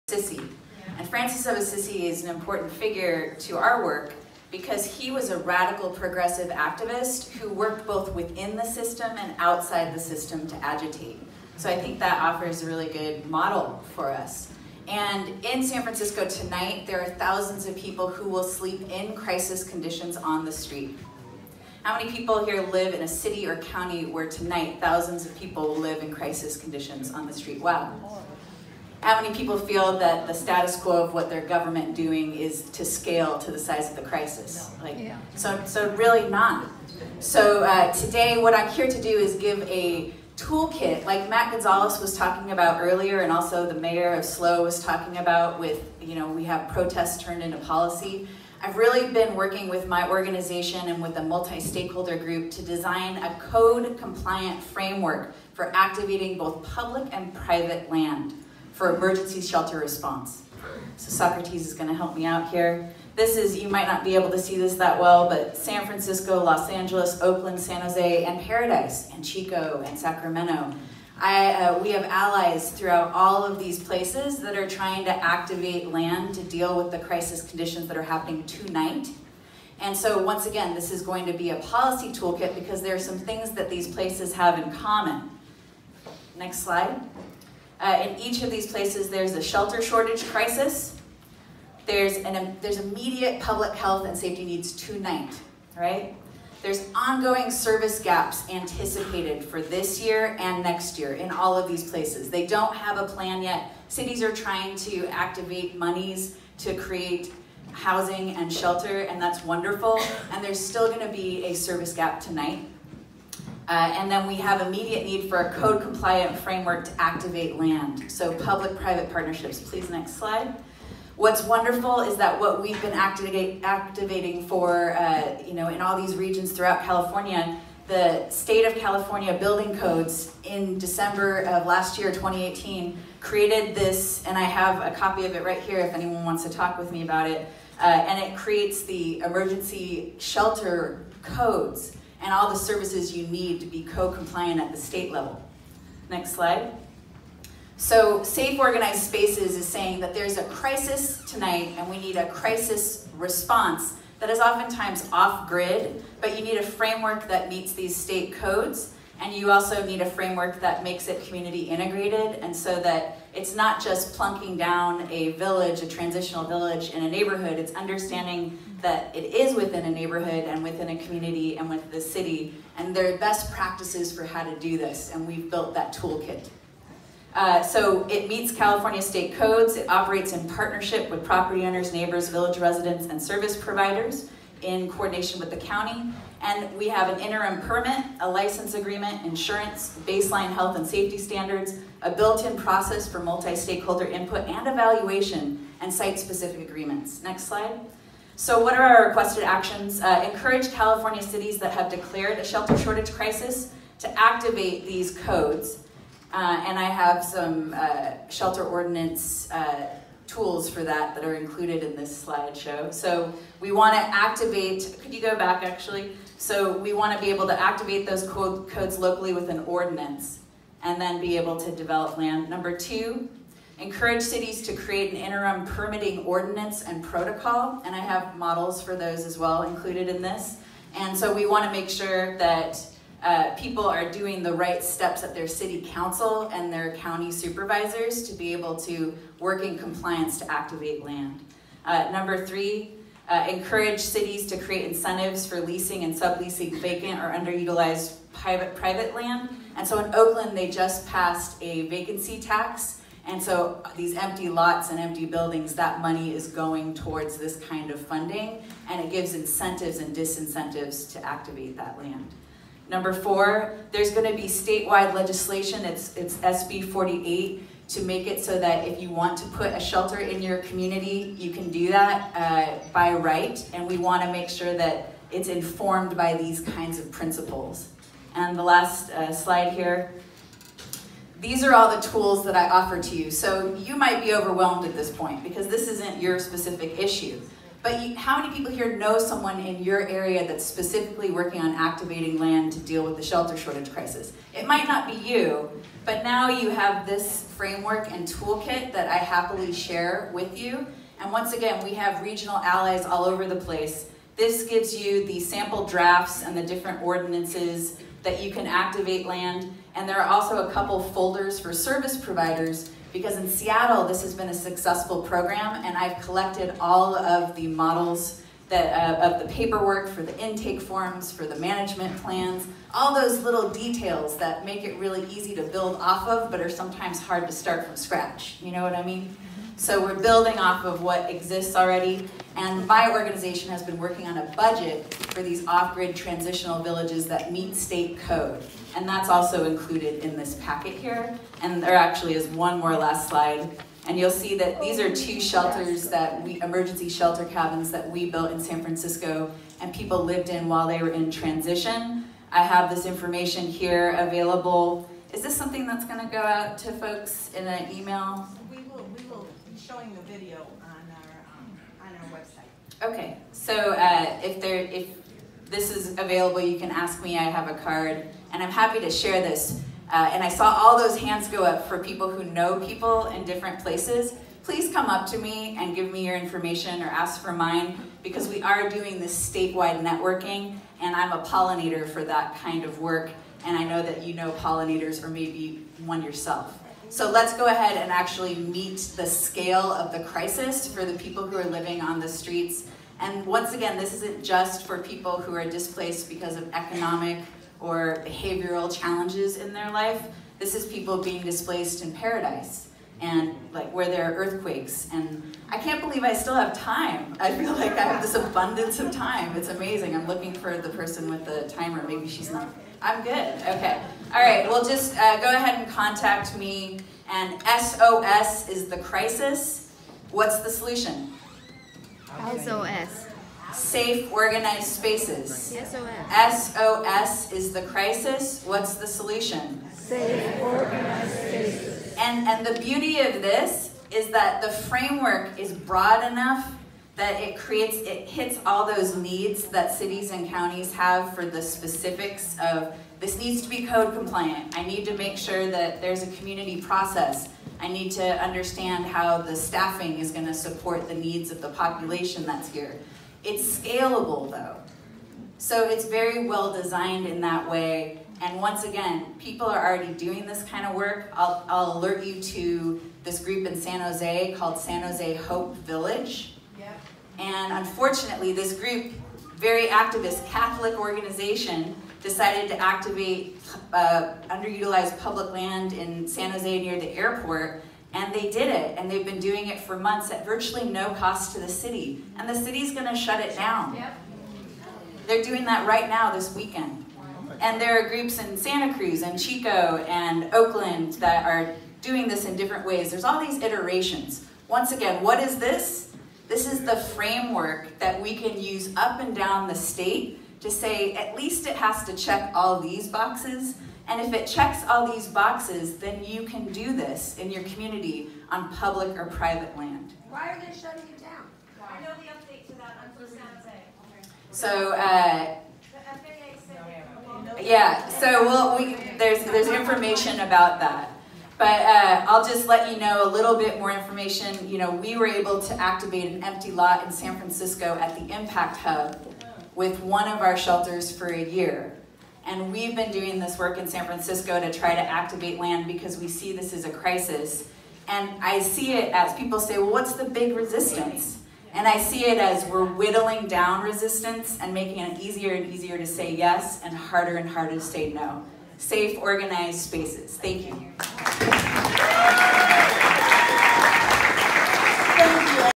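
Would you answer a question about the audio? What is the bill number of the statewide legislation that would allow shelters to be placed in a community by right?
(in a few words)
SB 48.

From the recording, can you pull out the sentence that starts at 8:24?
And if it checks all these boxes, then you can do this in your community on public or private land.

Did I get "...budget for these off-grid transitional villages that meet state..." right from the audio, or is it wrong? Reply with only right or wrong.
right.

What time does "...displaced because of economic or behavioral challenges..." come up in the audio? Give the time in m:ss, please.
6:35.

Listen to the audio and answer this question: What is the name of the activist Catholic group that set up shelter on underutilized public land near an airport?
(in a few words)
San Jose Hope Village.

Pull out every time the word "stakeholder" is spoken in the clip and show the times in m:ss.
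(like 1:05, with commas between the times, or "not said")
0:51, 3:13.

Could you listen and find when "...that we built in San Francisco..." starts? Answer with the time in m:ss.
5:47.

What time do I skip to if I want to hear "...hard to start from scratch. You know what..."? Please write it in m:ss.
5:27.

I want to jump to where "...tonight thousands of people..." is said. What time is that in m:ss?
0:24.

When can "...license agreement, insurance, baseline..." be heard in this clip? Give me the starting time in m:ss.
3:08.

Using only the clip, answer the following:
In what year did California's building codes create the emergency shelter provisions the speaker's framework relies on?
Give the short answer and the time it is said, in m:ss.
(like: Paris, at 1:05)
2018, at 2:12.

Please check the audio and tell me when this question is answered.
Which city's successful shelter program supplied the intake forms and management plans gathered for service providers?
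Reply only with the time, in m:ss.
5:13.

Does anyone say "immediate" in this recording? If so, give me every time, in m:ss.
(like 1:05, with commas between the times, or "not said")
1:32, 1:54.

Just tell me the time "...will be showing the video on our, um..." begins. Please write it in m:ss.
5:59.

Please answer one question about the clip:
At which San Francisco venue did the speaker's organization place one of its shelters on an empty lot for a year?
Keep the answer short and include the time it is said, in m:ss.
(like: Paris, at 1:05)
Impact Hub, at 8:48.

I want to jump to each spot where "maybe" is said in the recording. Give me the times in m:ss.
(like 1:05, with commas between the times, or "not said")
6:25, 6:52.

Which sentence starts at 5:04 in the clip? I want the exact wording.
This gives you the sample drafts and the different ordinances that you can activate land.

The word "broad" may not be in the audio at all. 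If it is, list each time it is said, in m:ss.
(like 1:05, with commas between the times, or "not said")
7:15.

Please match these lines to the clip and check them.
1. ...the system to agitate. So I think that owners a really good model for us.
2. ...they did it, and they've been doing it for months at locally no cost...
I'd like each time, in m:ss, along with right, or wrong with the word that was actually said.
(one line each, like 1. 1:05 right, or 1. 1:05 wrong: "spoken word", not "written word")
1. 0:09 wrong: "offers", not "owners"
2. 7:58 wrong: "virtually", not "locally".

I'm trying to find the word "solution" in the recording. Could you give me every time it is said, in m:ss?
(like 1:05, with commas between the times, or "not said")
7:00, 7:09.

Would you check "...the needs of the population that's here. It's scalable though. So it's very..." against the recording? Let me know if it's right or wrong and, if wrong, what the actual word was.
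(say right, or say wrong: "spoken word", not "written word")
right.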